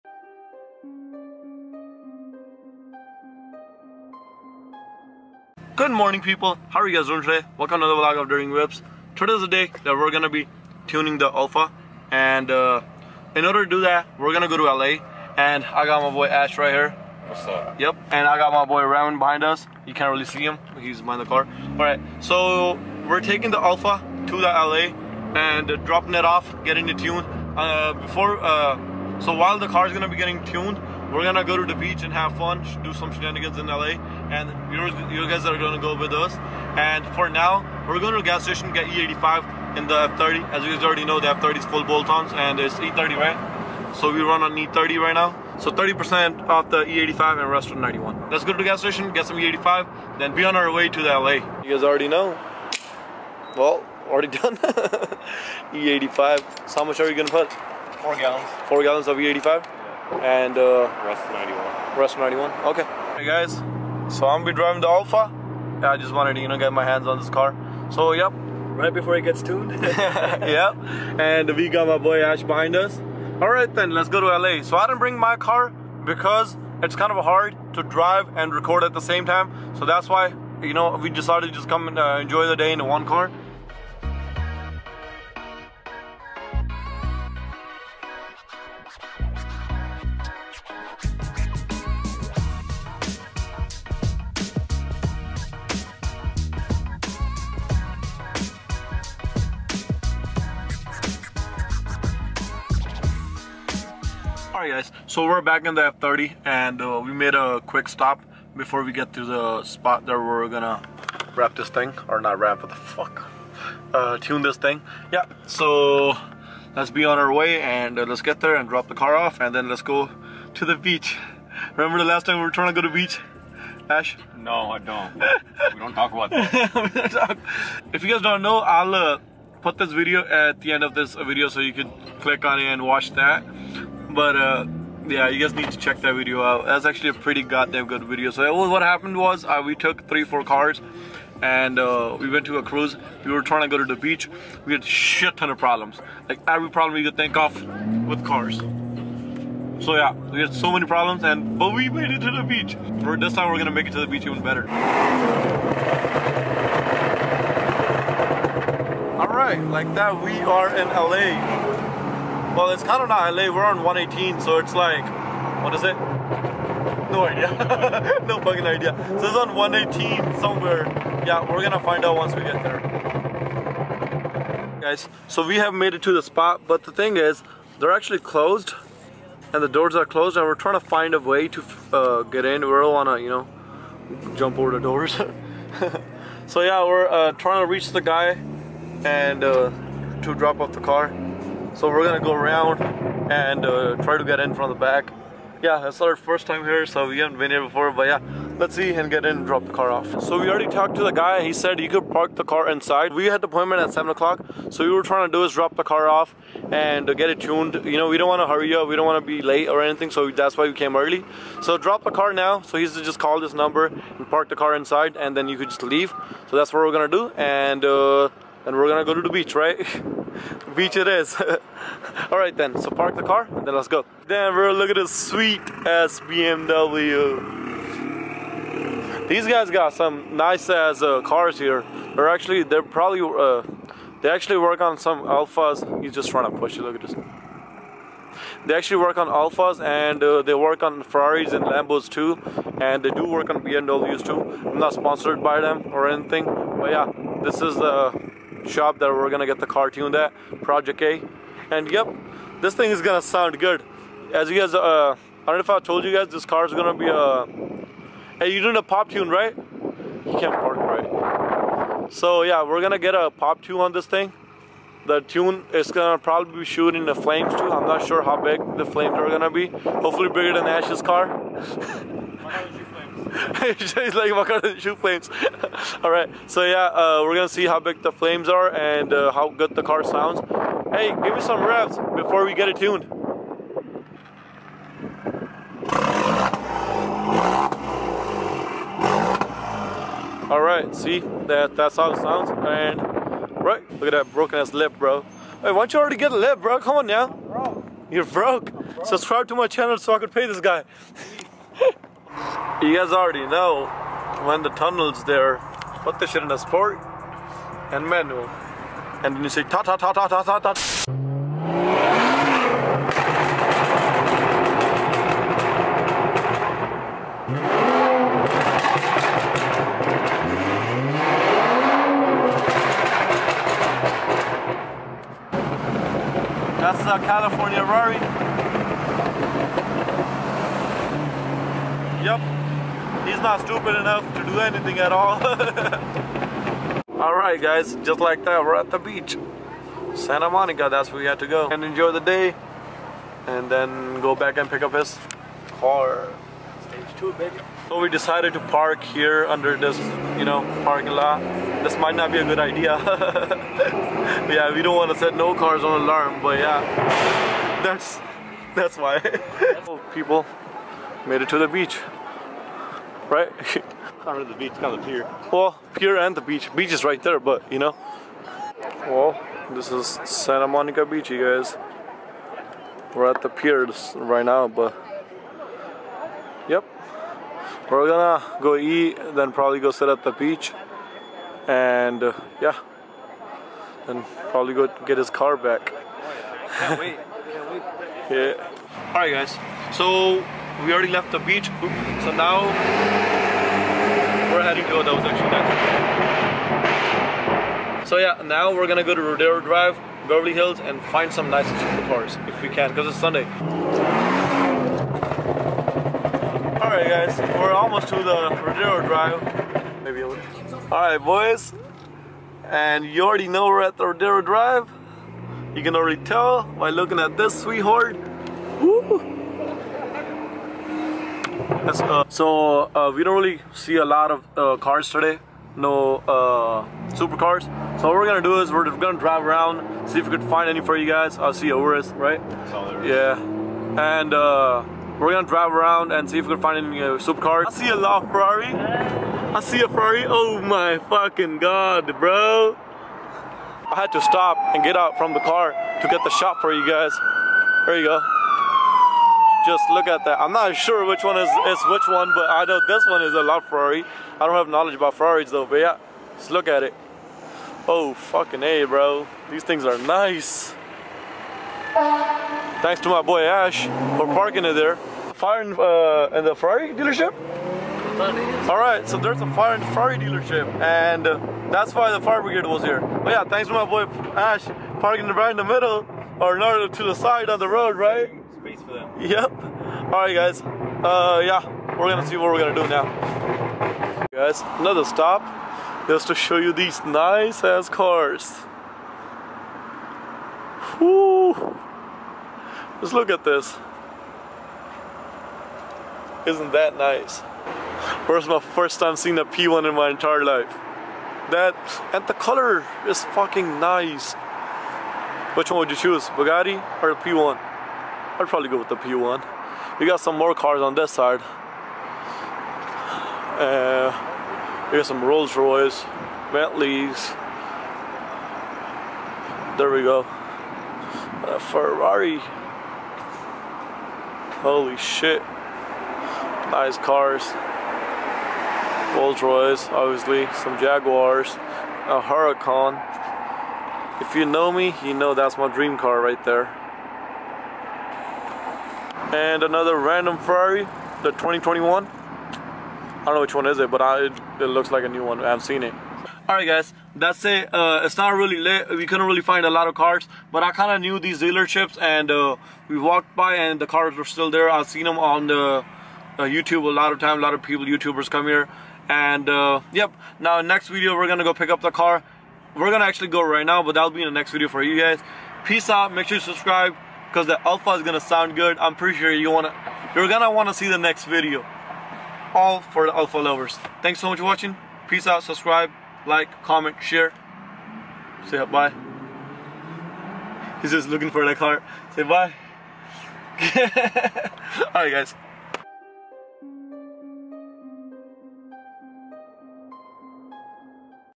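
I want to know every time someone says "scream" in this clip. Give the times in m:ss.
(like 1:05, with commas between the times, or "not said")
not said.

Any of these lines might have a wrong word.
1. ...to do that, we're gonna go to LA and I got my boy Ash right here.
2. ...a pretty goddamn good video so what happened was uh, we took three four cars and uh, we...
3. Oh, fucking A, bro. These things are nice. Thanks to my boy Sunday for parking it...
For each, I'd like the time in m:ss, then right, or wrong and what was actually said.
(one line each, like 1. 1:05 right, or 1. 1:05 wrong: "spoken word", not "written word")
1. 0:13 right
2. 2:17 right
3. 7:37 wrong: "Ash", not "Sunday".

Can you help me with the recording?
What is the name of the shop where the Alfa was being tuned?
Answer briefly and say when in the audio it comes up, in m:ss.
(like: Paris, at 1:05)
Project A, at 4:10.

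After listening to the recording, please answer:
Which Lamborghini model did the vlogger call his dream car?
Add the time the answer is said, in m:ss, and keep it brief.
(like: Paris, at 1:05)
Huracan, at 8:52.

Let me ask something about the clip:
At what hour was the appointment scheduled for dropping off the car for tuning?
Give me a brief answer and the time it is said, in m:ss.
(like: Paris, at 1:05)
7 o'clock, at 3:23.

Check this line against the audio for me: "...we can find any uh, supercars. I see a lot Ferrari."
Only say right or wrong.
right.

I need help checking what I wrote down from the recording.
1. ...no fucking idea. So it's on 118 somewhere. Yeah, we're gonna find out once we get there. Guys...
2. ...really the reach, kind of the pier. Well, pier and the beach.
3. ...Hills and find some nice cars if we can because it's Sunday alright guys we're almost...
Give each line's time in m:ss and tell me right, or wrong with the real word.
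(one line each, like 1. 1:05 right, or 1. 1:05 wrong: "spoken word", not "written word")
1. 2:48 right
2. 6:04 wrong: "beach", not "reach"
3. 6:40 right.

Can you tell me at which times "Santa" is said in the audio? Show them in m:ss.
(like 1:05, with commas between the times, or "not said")
5:40, 6:10.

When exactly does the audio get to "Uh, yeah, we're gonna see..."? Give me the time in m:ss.
8:00.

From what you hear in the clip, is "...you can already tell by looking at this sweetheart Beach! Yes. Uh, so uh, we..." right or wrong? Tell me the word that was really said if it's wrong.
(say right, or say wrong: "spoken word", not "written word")
wrong: "Woo", not "Beach".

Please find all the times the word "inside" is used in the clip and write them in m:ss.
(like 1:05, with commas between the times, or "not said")
3:22, 3:34.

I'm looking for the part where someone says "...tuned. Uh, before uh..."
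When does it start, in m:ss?
0:26.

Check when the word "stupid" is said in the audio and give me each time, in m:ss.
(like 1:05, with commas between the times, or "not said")
5:33.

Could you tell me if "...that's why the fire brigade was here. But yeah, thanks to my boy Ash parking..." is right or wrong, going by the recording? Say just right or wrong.
right.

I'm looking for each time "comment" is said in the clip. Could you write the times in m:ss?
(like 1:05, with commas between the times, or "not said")
9:36.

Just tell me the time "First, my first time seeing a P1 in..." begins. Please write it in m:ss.
8:18.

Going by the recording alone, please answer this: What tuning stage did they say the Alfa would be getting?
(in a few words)
Stage two.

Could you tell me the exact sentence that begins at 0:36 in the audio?
And for now, we're going to a gas station get E85 in the F30.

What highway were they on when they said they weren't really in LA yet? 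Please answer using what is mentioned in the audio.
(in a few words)
118.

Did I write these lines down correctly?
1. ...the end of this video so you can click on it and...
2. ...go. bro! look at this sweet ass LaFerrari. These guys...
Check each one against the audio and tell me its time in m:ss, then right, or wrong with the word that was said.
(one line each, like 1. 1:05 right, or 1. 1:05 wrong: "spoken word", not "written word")
1. 2:10 right
2. 3:43 wrong: "BMW", not "LaFerrari".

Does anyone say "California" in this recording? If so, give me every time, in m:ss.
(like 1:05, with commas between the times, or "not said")
5:27.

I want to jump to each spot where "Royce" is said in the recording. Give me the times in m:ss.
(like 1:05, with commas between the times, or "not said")
8:35, 8:49.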